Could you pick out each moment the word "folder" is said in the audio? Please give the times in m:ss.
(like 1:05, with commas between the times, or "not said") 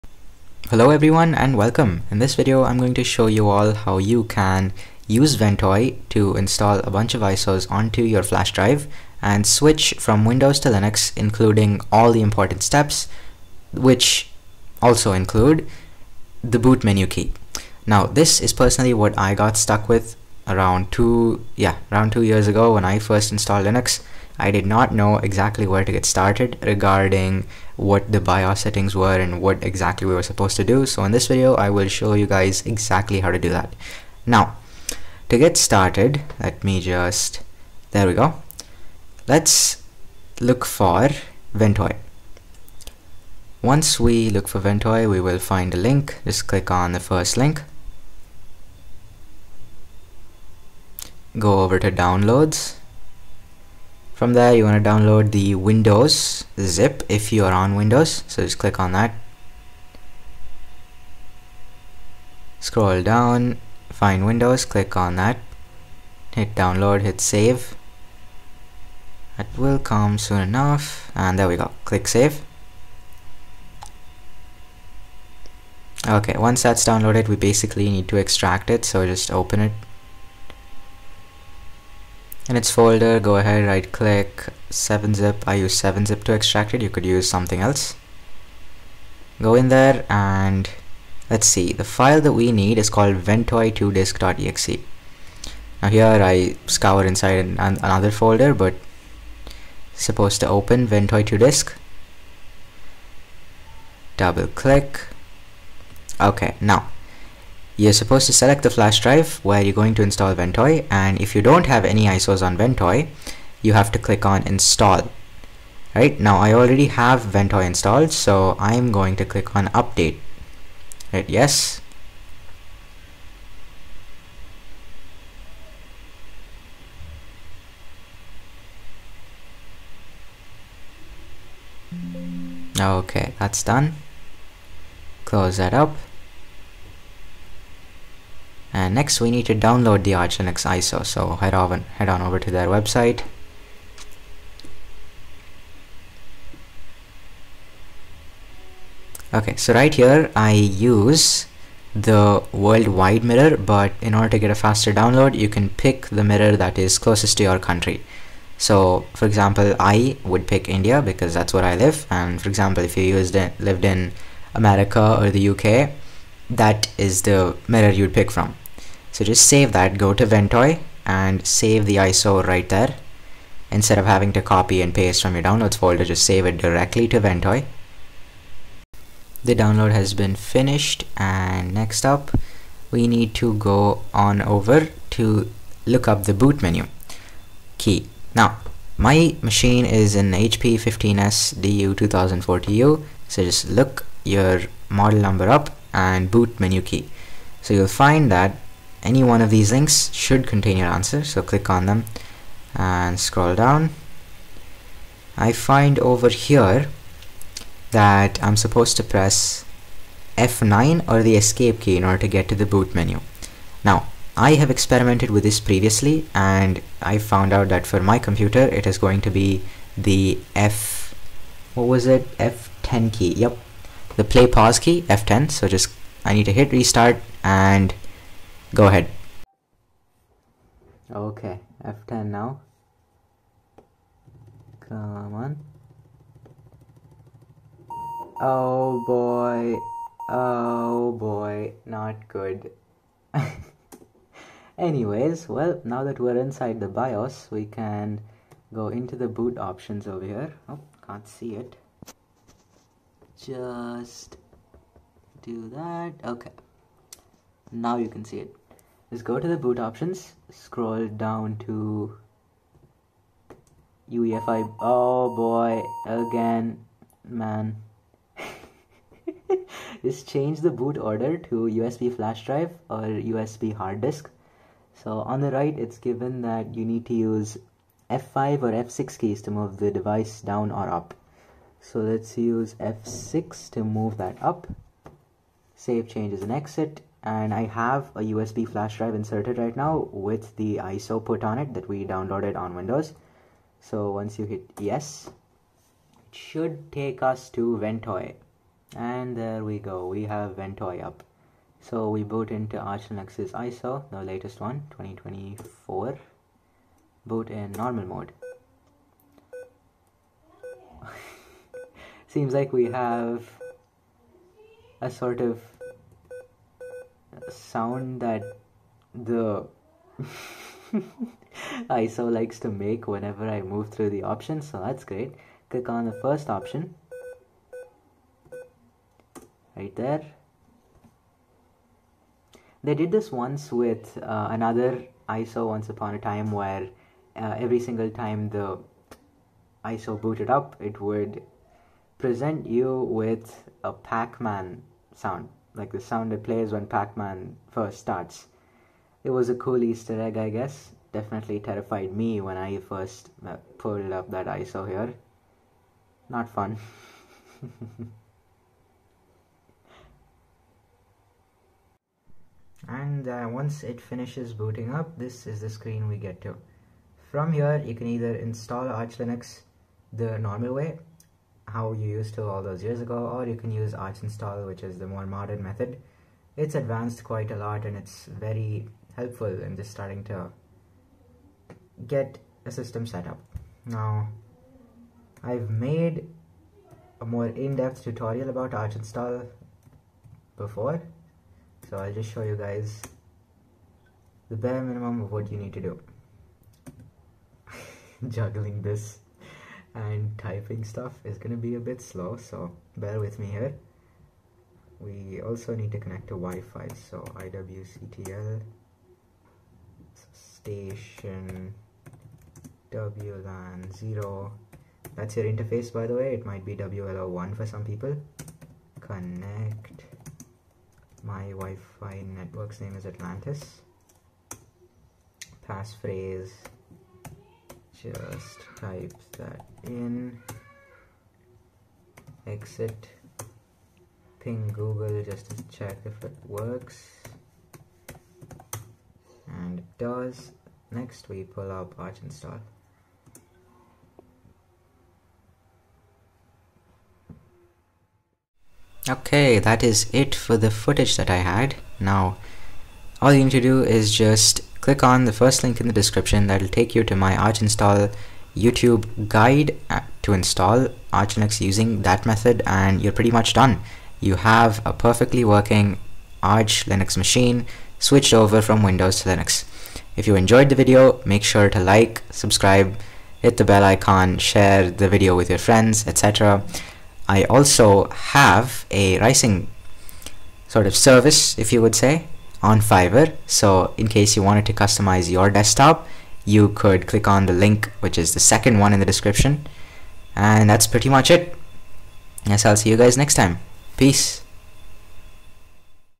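1:22, 1:38, 2:55.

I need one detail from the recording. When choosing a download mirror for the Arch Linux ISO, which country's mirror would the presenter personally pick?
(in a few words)
India.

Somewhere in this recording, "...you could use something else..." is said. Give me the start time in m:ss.
1:26.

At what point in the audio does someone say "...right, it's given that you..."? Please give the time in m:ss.
4:35.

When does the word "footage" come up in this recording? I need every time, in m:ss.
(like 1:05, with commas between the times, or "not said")
7:30.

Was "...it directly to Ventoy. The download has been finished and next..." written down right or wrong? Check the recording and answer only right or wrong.
right.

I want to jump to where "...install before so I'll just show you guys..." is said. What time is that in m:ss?
6:28.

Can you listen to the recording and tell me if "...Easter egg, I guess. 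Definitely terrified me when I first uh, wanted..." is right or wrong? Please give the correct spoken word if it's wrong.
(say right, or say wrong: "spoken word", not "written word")
wrong: "pulled", not "wanted".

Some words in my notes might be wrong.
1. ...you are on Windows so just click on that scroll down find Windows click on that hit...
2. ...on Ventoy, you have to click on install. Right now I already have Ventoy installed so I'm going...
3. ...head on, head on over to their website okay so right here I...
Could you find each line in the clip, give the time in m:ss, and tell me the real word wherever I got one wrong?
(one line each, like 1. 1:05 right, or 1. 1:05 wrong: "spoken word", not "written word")
1. 0:57 right
2. 1:52 right
3. 2:21 right.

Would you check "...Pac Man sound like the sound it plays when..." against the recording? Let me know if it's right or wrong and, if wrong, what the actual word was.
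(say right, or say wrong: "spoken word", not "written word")
right.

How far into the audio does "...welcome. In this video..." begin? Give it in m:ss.
0:01.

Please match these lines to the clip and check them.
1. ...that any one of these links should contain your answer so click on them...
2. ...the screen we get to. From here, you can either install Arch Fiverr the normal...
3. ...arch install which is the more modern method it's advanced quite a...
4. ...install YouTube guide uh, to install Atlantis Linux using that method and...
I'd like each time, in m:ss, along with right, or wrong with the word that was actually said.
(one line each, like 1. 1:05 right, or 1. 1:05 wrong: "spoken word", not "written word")
1. 3:18 right
2. 6:05 wrong: "Linux", not "Fiverr"
3. 6:13 right
4. 7:37 wrong: "Arch", not "Atlantis".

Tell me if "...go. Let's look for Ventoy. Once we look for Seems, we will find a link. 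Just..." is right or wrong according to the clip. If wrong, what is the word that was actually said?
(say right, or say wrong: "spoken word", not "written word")
wrong: "Ventoy", not "Seems".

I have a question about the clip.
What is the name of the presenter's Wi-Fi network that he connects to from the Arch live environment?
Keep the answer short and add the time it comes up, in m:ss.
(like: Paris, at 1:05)
Atlantis, at 7:03.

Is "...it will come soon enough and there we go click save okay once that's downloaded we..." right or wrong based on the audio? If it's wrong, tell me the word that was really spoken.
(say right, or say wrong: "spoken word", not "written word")
right.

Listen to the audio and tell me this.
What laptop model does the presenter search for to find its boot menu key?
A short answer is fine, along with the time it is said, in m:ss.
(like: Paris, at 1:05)
HP 15S DU 2040, at 3:10.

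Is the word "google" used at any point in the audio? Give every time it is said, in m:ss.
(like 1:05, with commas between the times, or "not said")
7:14.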